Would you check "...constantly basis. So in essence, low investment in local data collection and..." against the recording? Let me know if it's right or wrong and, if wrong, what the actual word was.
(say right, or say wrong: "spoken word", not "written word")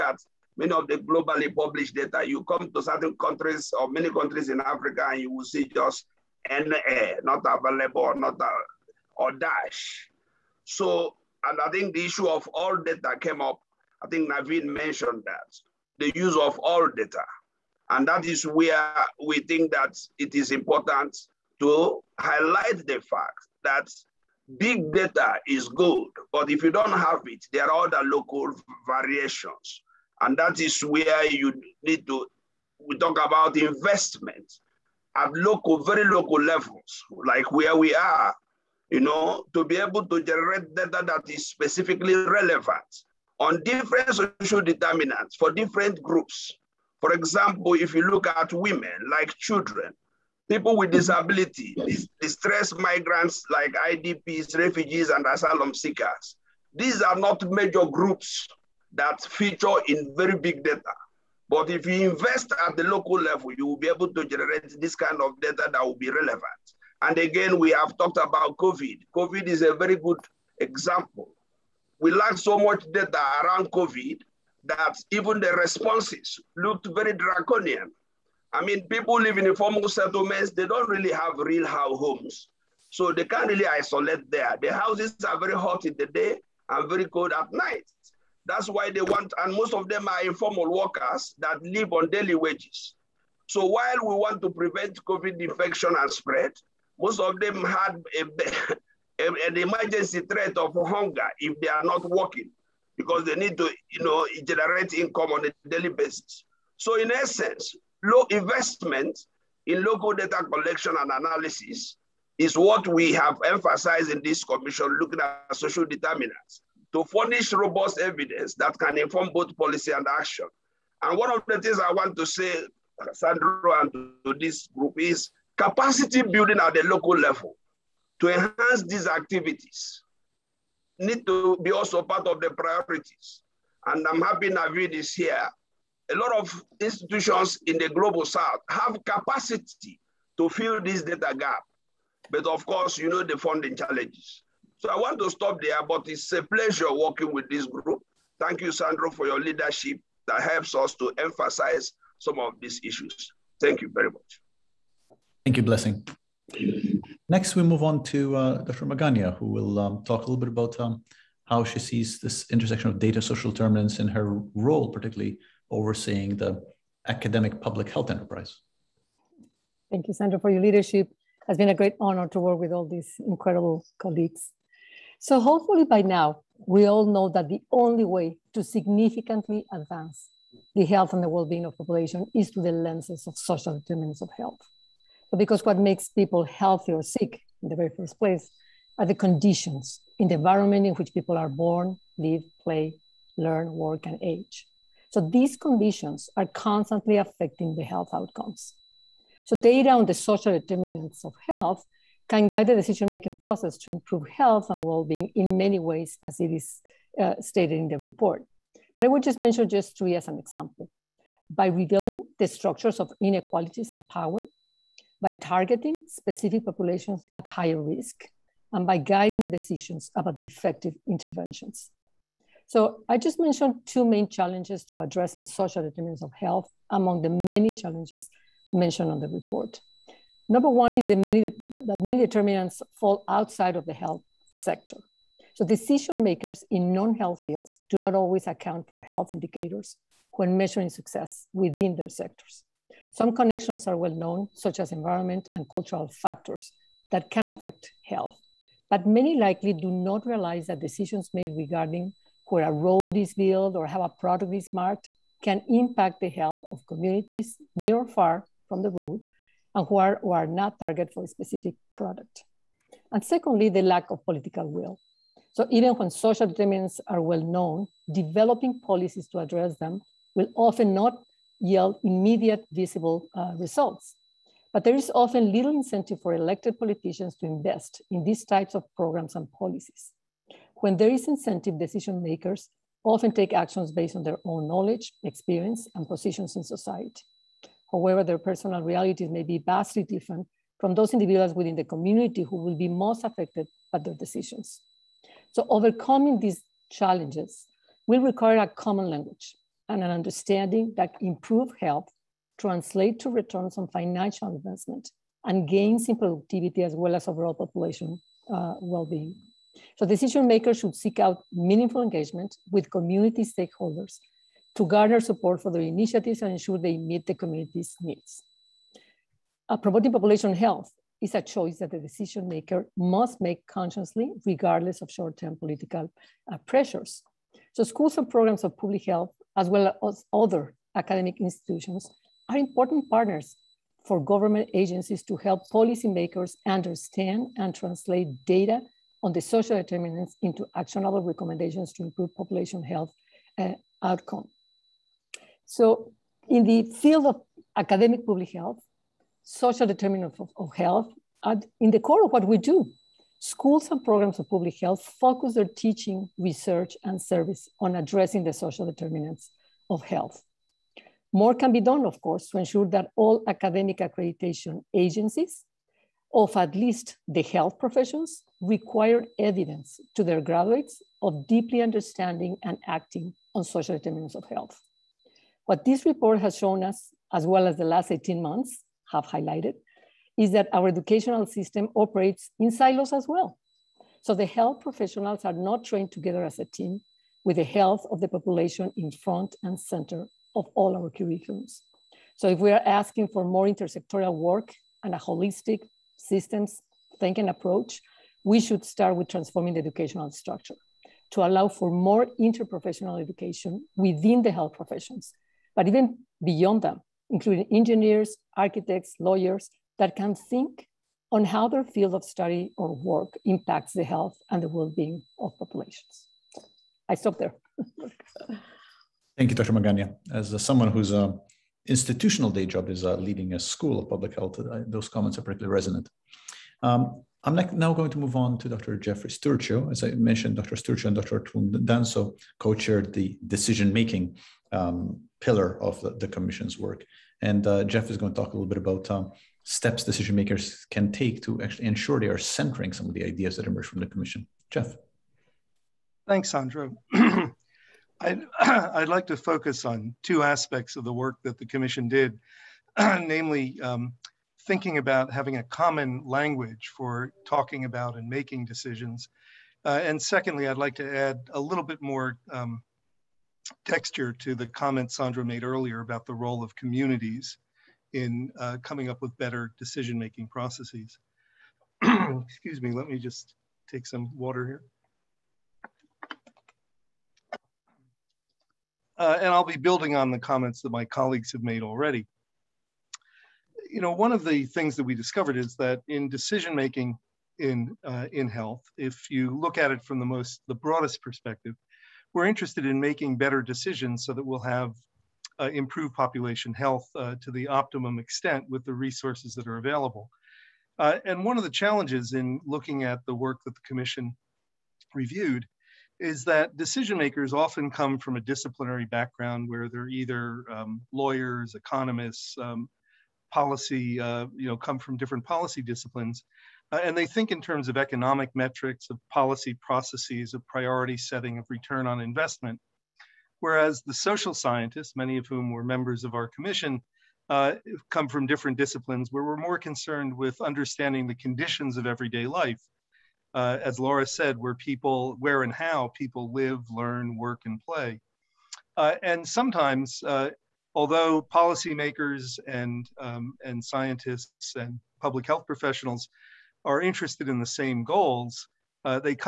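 wrong: "daily", not "constantly".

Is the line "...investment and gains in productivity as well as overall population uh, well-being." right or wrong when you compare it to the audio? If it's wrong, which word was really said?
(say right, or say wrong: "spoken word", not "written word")
right.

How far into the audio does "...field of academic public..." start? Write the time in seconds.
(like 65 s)
347 s.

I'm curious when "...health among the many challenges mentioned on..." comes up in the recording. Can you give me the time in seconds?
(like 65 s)
226 s.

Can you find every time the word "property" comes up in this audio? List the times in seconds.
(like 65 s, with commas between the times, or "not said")
not said.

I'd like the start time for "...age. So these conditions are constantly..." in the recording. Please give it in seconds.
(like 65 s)
194 s.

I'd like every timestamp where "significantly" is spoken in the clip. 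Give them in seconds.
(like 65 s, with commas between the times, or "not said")
178 s.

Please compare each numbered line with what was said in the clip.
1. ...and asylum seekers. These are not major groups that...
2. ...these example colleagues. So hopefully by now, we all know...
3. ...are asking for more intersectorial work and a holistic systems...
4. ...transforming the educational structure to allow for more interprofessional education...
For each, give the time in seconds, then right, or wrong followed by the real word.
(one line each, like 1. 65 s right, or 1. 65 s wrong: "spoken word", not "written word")
1. 55 s right
2. 172 s wrong: "incredible", not "example"
3. 392 s right
4. 399 s right.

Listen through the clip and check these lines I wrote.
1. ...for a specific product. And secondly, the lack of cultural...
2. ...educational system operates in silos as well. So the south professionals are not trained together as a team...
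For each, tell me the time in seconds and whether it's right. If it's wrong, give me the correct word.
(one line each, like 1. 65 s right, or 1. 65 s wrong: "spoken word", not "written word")
1. 261 s wrong: "political", not "cultural"
2. 380 s wrong: "health", not "south".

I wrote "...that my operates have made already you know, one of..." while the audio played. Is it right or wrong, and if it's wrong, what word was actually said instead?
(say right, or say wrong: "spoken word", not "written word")
wrong: "colleagues", not "operates".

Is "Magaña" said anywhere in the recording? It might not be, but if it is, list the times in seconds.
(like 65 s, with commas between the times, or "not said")
158 s, 419 s.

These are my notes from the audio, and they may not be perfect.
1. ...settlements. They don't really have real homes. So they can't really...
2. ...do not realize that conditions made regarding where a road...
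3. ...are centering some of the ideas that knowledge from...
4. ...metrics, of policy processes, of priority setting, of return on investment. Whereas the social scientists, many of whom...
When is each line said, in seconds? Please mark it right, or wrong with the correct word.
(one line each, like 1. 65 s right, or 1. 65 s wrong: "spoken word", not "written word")
1. 79 s right
2. 249 s wrong: "decisions", not "conditions"
3. 442 s wrong: "emerge", not "knowledge"
4. 518 s right.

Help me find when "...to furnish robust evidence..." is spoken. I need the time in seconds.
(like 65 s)
116 s.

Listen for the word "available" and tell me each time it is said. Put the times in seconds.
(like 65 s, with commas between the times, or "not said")
7 s, 499 s.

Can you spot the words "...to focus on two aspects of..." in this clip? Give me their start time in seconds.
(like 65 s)
449 s.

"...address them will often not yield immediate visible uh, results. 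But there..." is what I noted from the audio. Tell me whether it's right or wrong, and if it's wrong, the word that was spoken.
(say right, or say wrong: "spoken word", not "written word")
right.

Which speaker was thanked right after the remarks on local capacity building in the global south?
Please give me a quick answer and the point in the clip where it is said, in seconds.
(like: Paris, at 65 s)
Blessing, at 155 s.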